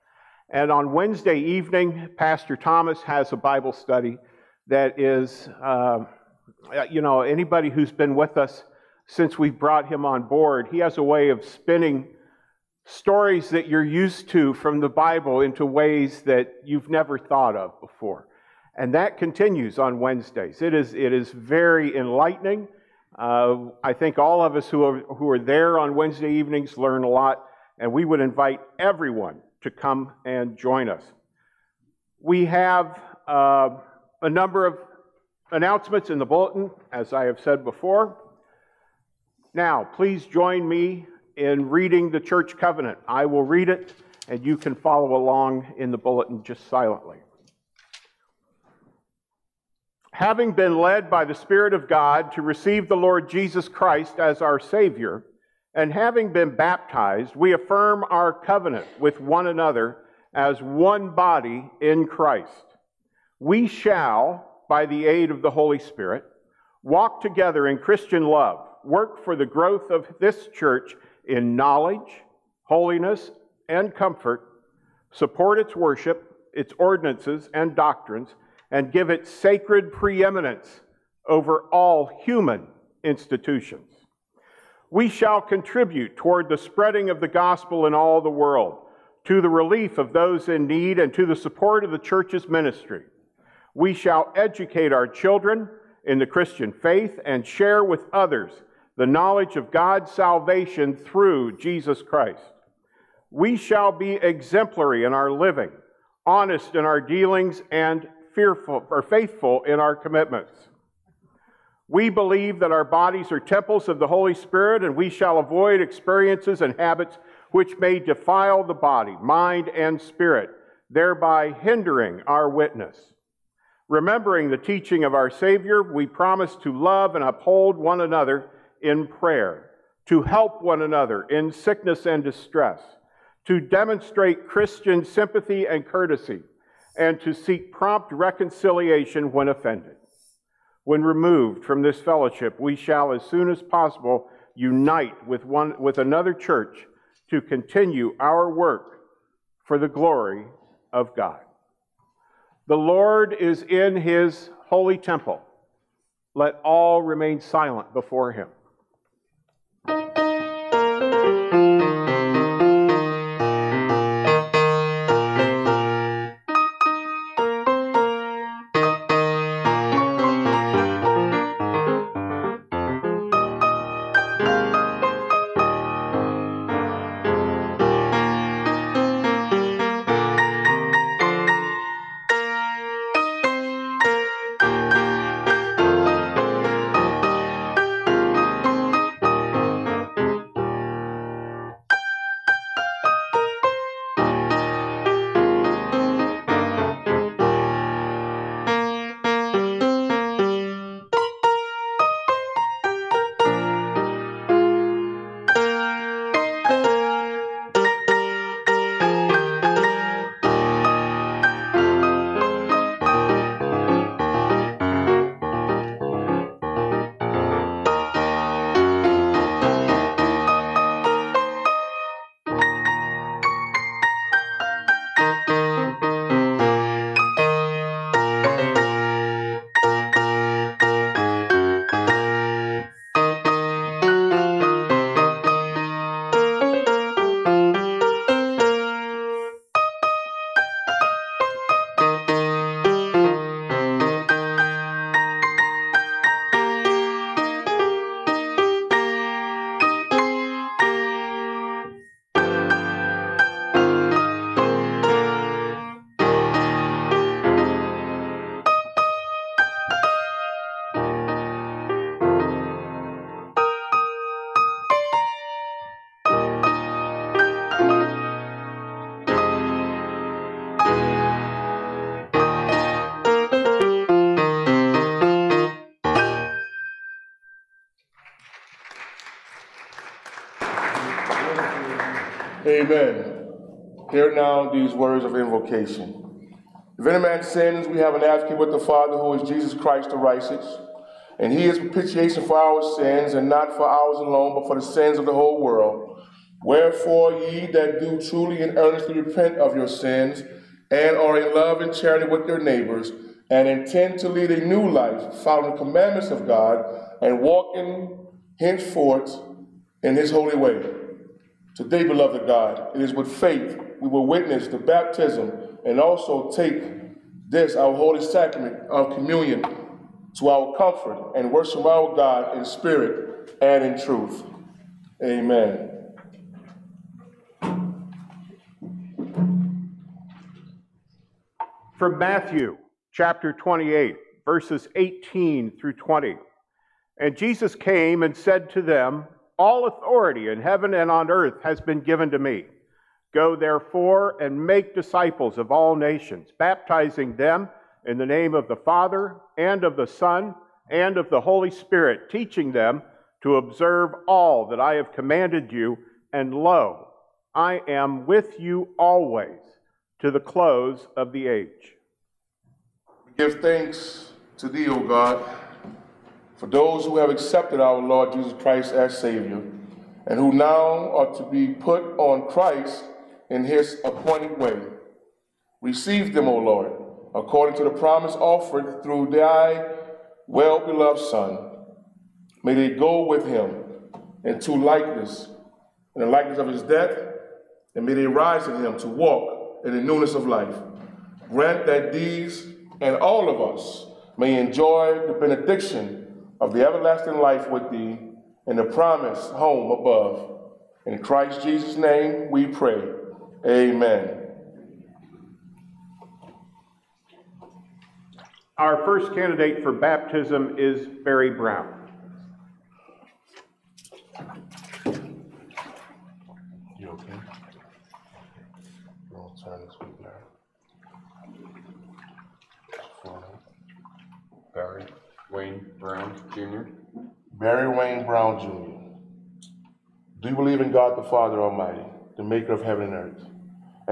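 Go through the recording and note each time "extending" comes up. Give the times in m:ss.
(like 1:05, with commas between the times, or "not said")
not said.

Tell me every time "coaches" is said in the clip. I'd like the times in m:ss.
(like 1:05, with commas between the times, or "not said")
not said.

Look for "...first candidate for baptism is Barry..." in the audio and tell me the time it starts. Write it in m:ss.
6:49.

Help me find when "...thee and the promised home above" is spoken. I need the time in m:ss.
6:37.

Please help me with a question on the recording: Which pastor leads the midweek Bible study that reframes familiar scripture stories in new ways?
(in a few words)
Pastor Thomas.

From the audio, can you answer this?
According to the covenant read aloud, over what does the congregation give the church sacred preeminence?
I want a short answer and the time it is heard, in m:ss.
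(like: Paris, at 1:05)
all human institutions, at 1:21.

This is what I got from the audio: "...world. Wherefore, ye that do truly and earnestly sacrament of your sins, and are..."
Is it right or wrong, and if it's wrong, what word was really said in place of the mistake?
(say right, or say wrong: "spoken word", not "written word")
wrong: "repent", not "sacrament".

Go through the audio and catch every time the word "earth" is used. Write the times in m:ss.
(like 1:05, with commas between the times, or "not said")
5:41, 7:13.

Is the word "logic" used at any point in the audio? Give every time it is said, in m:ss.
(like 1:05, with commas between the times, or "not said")
not said.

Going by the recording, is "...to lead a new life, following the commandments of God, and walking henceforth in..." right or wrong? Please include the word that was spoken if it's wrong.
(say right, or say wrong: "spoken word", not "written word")
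right.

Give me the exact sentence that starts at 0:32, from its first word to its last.
We have uh, a number of announcements in the bulletin, as I have said before.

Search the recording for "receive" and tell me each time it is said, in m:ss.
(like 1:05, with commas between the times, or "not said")
0:52, 6:15.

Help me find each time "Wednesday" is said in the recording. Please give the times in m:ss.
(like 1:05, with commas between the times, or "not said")
0:00, 0:19, 0:25.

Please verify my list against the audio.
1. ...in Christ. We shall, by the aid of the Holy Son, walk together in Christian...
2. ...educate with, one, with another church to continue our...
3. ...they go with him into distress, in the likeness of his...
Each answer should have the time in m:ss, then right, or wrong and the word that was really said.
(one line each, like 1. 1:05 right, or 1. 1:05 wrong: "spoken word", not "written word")
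1. 1:01 wrong: "Spirit", not "Son"
2. 2:24 wrong: "unite", not "educate"
3. 6:22 wrong: "likeness", not "distress".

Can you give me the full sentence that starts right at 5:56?
And lo, I am with you always to the close of the age.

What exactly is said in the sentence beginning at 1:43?
We shall be exemplary in our living, honest in our dealings, and fearful or faithful in our commitments.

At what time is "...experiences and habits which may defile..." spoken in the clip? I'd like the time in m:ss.
1:55.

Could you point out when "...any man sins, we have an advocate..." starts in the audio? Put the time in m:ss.
4:47.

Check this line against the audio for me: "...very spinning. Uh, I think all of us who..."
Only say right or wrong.
wrong.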